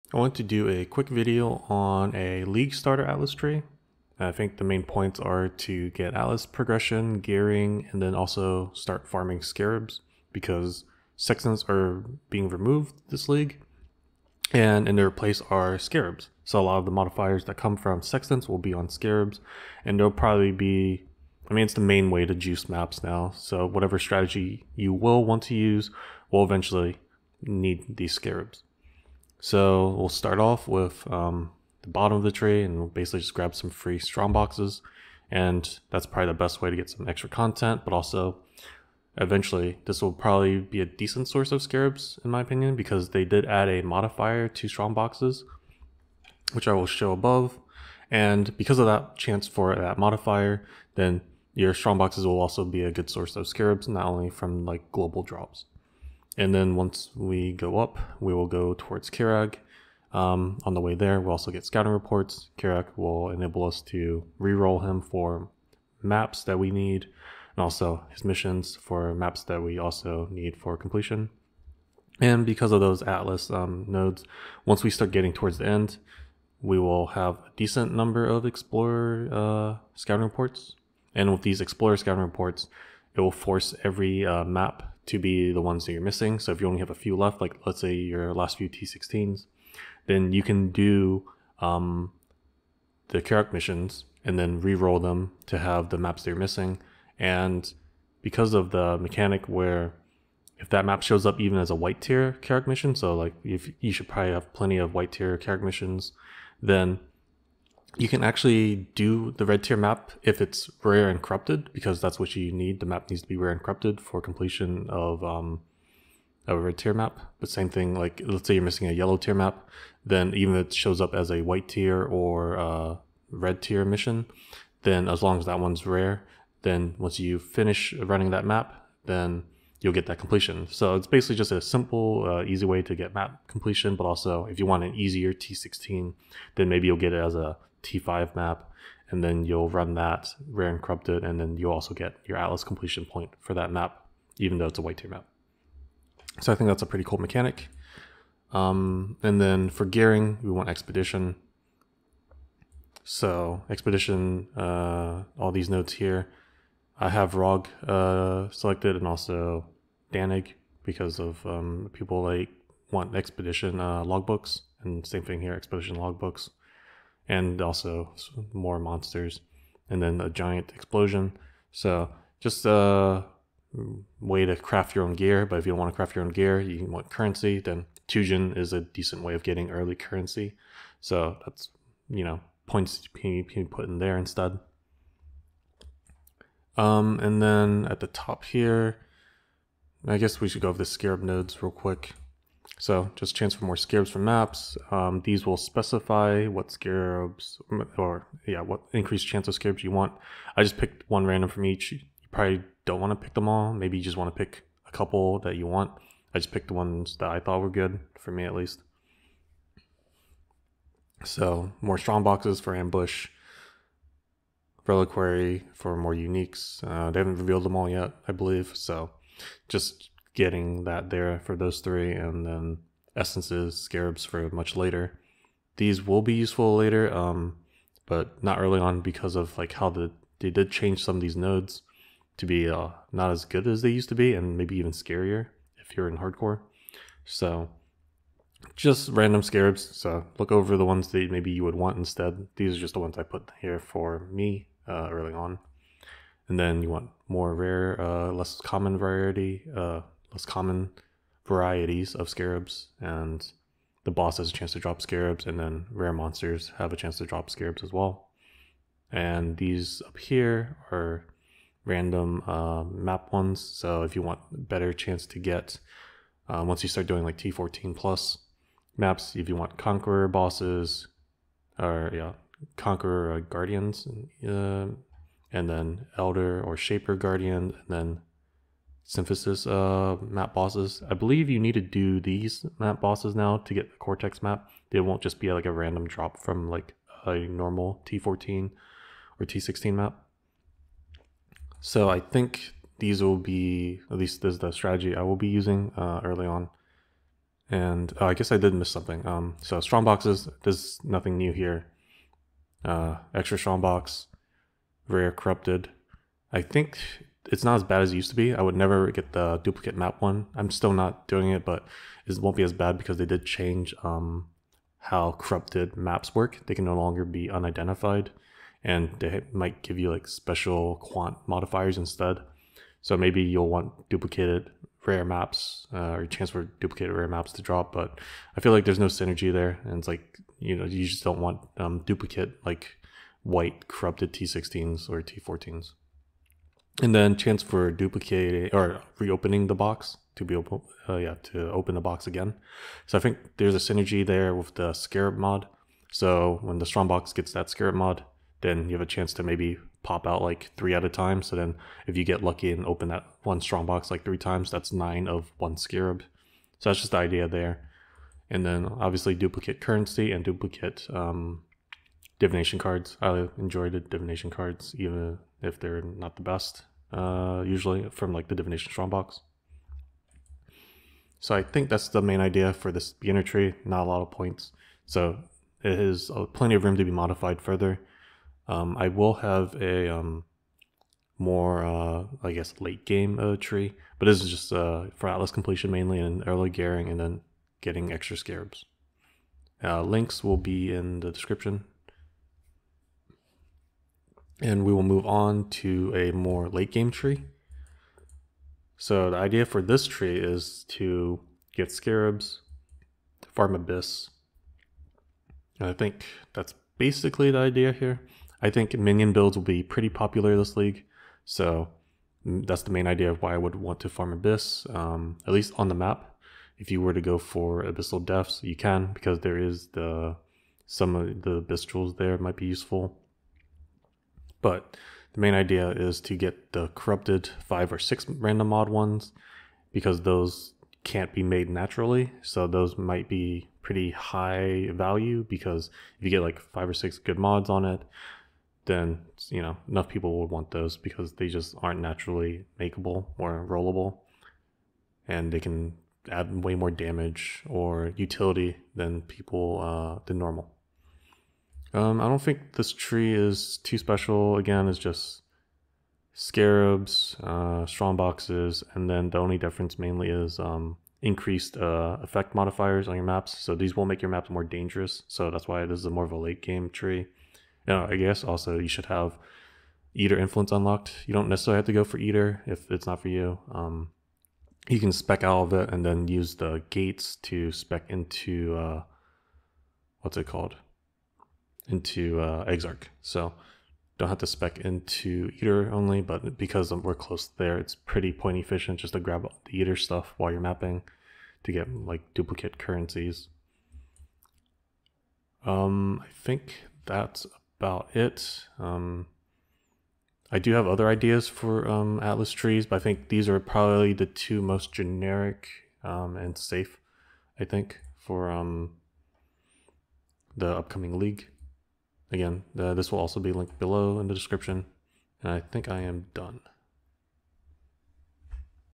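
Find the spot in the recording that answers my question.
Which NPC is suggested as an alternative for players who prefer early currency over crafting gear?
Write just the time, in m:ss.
2:58.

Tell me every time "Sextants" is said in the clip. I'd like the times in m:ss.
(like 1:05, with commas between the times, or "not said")
0:11, 0:18.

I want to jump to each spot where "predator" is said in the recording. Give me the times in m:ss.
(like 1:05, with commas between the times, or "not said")
not said.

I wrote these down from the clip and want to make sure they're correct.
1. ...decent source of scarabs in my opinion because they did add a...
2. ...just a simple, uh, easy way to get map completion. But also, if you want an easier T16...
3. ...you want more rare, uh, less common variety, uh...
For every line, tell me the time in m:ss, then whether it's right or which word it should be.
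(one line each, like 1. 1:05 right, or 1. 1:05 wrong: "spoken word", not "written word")
1. 0:40 right
2. 2:11 right
3. 4:06 right.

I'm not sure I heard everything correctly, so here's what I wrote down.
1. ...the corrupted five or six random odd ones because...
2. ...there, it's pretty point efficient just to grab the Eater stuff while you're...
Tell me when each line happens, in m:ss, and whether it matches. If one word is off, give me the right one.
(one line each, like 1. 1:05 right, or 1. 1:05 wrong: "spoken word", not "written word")
1. 7:06 right
2. 8:07 right.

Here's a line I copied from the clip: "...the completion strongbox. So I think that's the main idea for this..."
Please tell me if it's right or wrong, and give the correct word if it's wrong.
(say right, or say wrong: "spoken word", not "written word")
wrong: "divination", not "completion".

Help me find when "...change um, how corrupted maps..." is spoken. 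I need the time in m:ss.
5:13.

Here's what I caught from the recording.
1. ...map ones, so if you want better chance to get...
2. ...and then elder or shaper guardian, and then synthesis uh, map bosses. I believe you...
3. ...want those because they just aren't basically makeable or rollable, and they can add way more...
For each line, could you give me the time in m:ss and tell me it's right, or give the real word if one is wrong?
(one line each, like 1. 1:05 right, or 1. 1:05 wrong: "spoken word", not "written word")
1. 4:22 right
2. 4:35 right
3. 7:20 wrong: "naturally", not "basically".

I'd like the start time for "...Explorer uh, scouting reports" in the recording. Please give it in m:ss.
1:18.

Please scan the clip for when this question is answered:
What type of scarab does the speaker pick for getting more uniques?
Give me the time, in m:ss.
3:34.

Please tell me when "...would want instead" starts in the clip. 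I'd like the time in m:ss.
4:01.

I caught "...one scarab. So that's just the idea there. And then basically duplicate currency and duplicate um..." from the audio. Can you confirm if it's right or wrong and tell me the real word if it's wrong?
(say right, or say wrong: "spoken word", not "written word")
wrong: "obviously", not "basically".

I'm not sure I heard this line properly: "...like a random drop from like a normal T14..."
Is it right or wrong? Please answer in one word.
right.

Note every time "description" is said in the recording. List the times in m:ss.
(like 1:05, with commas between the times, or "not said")
6:31, 8:34.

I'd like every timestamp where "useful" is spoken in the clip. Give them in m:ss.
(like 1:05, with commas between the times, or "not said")
3:46, 7:02.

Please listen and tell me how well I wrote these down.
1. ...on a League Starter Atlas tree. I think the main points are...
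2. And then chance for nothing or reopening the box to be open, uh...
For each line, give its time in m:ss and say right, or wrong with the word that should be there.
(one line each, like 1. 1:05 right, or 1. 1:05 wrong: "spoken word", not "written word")
1. 0:01 right
2. 5:37 wrong: "duplicating", not "nothing".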